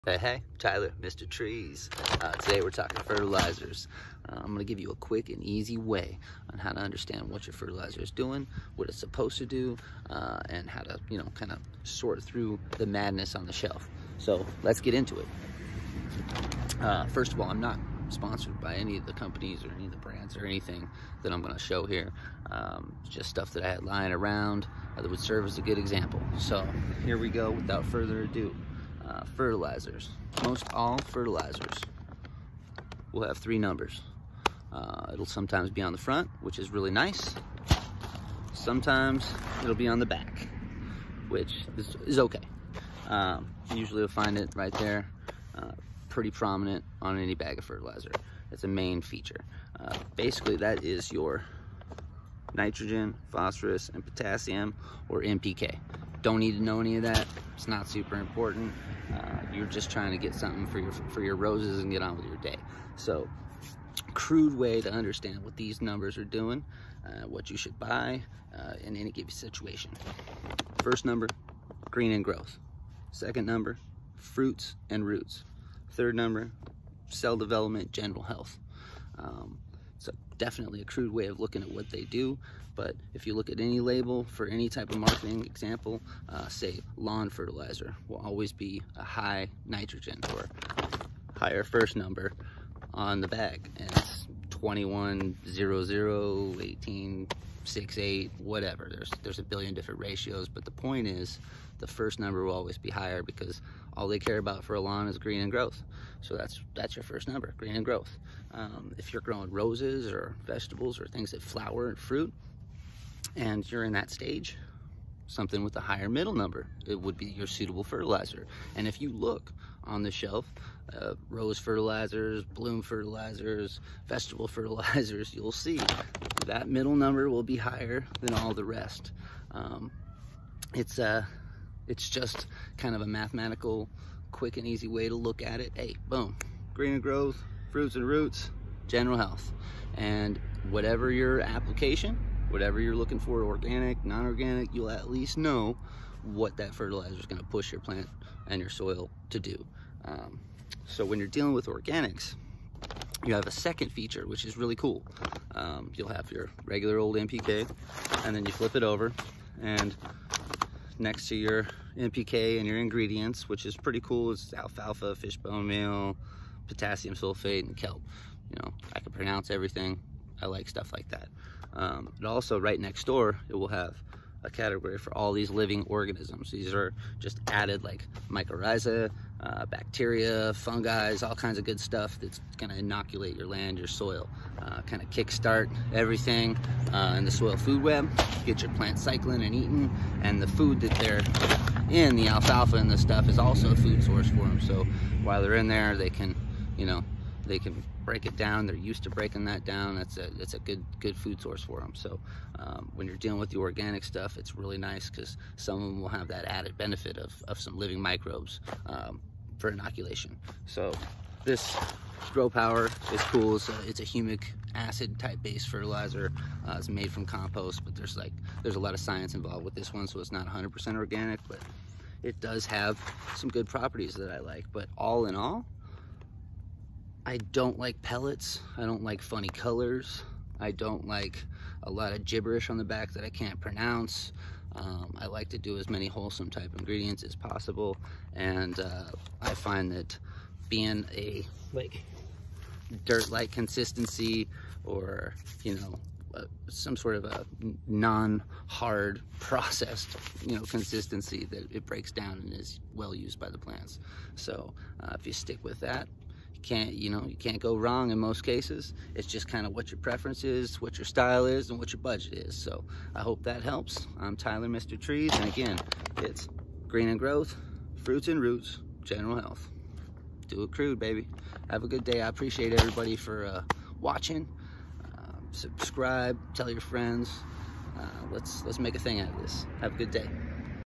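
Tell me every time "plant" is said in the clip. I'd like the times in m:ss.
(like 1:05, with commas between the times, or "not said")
2:27, 3:08, 4:13.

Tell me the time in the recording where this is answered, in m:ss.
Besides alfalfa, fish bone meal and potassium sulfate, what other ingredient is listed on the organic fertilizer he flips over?
2:47.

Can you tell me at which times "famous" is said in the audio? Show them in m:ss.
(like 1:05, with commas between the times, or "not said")
not said.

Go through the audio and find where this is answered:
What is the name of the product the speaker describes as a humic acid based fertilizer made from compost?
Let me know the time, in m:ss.
3:32.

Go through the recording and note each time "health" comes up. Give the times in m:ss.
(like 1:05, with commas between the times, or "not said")
1:18, 2:19, 4:29.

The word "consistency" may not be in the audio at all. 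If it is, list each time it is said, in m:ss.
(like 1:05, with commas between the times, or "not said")
4:03, 4:10.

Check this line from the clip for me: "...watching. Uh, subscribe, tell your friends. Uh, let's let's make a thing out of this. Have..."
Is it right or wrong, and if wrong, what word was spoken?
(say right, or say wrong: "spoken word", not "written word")
right.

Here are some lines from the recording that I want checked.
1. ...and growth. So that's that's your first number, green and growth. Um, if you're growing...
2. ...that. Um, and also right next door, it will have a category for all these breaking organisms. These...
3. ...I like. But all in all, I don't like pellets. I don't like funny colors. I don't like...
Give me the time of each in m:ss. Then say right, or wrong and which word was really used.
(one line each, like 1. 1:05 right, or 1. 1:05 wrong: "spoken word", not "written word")
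1. 1:45 right
2. 2:51 wrong: "living", not "breaking"
3. 3:44 right.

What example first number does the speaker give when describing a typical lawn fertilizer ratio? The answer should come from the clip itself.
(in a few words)
21.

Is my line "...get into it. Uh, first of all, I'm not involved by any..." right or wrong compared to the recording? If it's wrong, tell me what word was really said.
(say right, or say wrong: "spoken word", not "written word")
wrong: "sponsored", not "involved".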